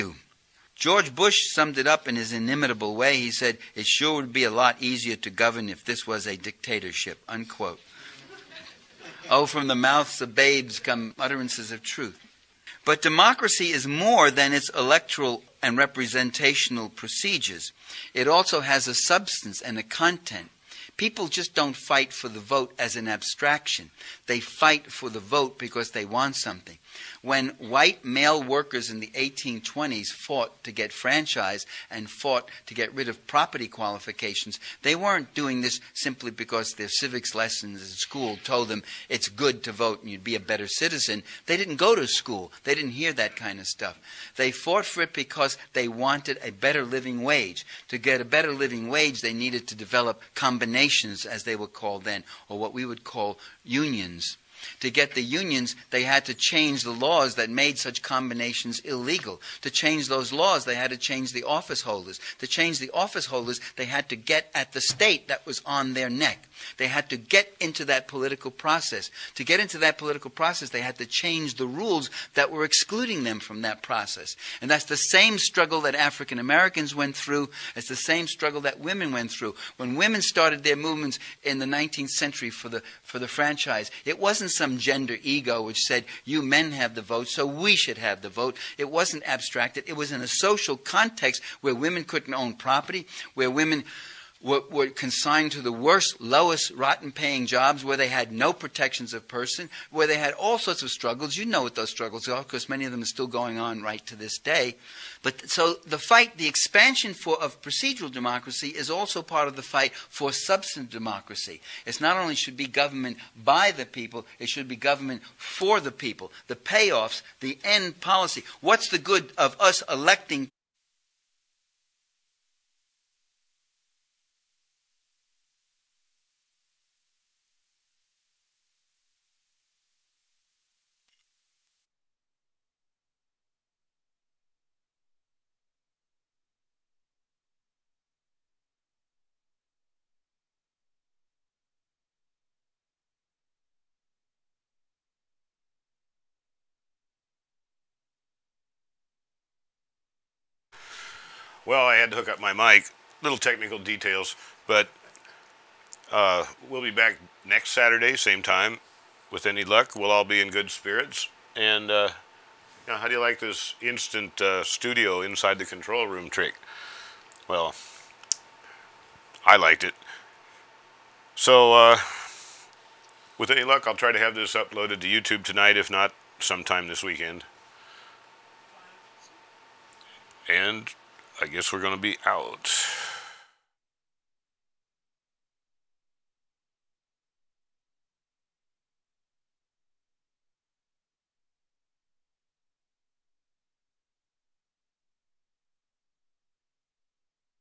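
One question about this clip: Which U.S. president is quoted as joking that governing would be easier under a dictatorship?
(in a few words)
George Bush.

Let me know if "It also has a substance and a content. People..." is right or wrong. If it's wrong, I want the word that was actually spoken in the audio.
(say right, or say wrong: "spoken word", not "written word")
right.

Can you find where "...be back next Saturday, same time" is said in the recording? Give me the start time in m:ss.
2:36.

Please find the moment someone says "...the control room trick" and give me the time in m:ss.
2:45.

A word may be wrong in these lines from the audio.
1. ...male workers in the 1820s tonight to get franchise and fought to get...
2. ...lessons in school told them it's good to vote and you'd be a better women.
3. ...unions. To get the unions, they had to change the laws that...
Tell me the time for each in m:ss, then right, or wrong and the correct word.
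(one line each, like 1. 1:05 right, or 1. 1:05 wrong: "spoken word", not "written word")
1. 0:28 wrong: "fought", not "tonight"
2. 0:37 wrong: "citizen", not "women"
3. 0:53 right.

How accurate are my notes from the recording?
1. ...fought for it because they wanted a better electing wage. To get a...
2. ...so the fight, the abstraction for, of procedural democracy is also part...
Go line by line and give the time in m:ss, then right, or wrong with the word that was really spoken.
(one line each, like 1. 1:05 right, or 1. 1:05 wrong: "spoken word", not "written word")
1. 0:44 wrong: "living", not "electing"
2. 1:45 wrong: "expansion", not "abstraction".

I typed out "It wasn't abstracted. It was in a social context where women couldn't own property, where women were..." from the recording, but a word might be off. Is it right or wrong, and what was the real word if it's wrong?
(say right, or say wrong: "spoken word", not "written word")
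right.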